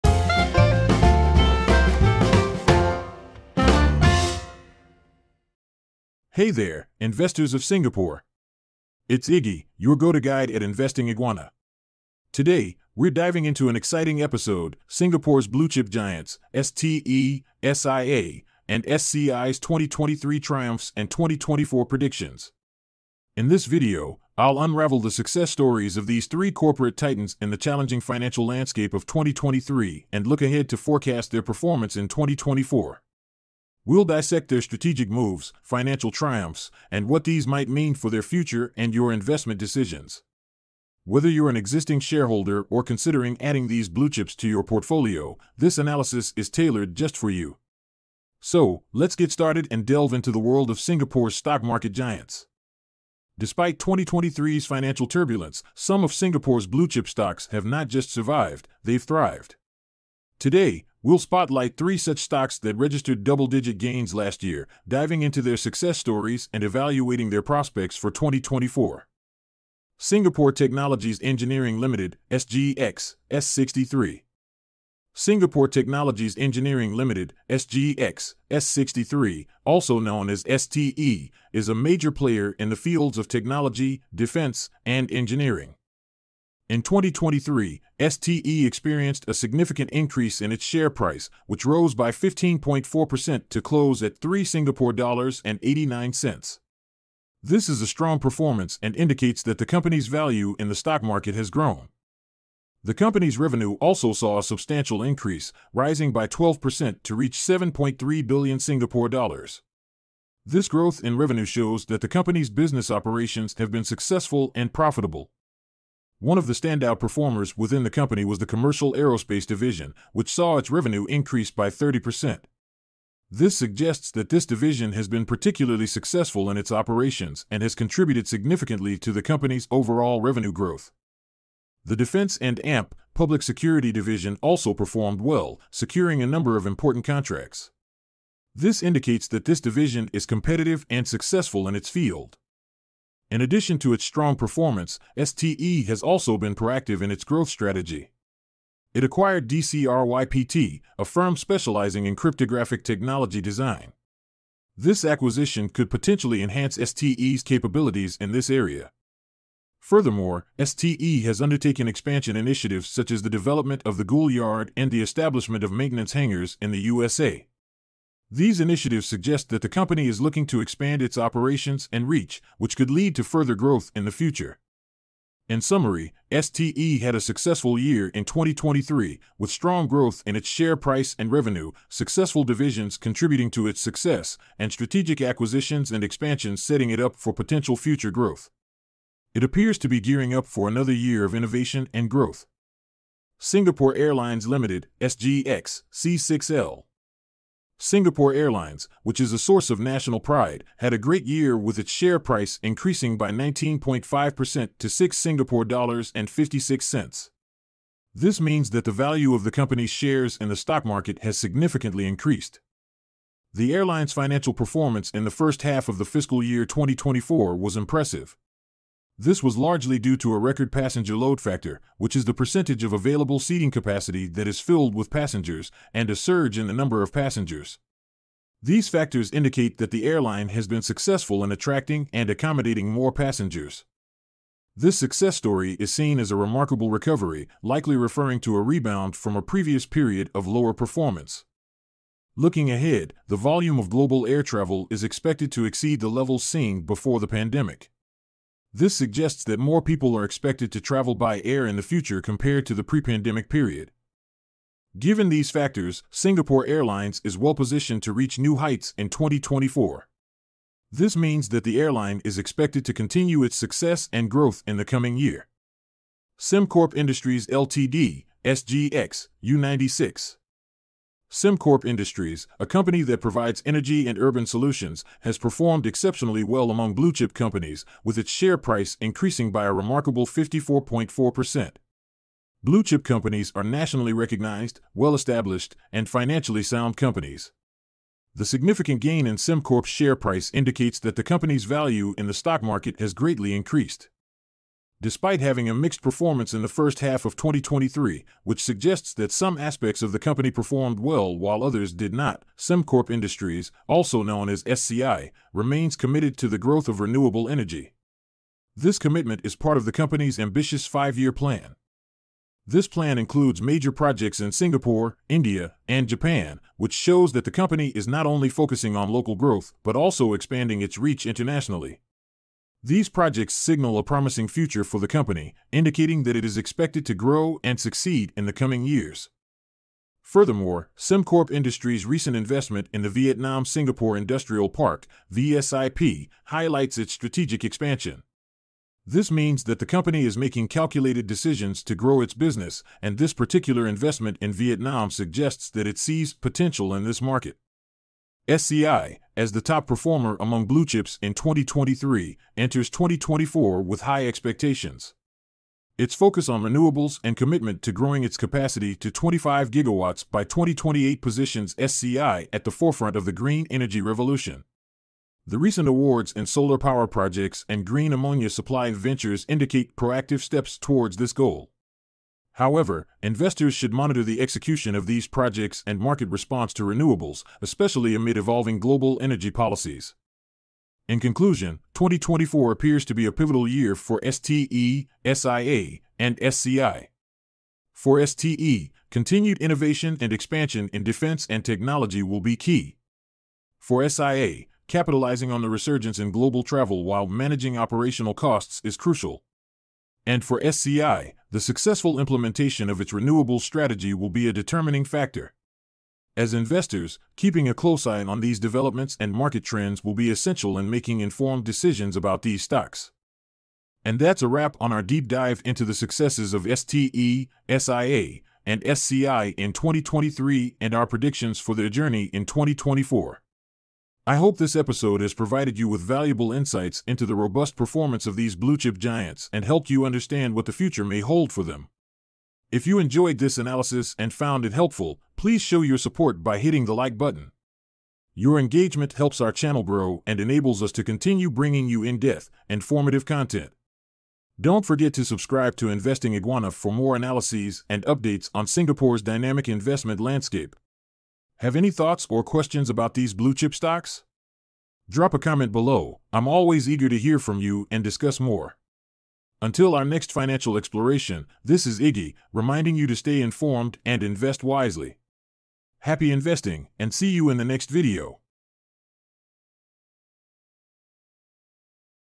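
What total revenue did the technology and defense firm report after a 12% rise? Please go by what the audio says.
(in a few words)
7.3 billion Singapore dollars.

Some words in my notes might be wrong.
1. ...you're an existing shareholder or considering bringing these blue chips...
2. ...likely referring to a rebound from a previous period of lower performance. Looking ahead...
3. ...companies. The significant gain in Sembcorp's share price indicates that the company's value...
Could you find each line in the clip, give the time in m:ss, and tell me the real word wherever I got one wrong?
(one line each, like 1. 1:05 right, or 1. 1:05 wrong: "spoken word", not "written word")
1. 0:41 wrong: "adding", not "bringing"
2. 3:57 right
3. 4:46 right.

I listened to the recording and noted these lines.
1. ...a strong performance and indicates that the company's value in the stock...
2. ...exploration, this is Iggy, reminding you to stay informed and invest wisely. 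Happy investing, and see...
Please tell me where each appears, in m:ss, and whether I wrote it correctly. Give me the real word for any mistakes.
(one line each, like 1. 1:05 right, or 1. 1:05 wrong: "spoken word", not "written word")
1. 1:37 right
2. 7:40 right.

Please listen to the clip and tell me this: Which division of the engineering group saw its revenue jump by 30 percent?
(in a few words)
Commercial aerospace.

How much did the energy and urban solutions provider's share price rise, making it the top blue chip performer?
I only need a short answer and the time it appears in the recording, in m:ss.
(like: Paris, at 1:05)
54.4%, at 4:40.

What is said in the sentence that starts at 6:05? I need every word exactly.
The recent awards in solar power projects and green ammonia supply ventures indicate proactive steps towards this goal.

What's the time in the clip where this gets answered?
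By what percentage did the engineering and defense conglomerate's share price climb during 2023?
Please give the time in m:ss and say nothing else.
1:32.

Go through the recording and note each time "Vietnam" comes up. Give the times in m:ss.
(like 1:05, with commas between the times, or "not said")
5:33, 5:44.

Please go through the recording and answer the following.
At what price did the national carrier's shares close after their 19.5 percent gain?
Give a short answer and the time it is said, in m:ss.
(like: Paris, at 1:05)
6.56 Singapore dollars, at 3:24.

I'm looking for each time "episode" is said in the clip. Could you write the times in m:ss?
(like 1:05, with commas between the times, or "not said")
0:14, 7:04.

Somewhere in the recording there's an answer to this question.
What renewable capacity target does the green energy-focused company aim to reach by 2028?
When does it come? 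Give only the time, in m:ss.
5:59.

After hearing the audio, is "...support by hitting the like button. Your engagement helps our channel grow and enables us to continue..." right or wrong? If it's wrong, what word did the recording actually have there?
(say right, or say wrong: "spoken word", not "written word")
right.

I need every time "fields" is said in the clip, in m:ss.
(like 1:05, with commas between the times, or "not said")
1:22, 2:21.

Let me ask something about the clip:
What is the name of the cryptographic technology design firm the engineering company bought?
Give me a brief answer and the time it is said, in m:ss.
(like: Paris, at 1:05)
DCRYPT, at 2:29.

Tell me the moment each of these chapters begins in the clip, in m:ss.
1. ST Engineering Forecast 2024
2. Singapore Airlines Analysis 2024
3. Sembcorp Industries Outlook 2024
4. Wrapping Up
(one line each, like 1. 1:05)
1. 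1:08
2. 3:13
3. 4:26
4. 6:52.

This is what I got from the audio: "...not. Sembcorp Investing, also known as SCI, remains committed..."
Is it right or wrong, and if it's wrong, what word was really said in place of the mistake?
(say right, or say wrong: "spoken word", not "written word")
wrong: "Industries", not "Investing".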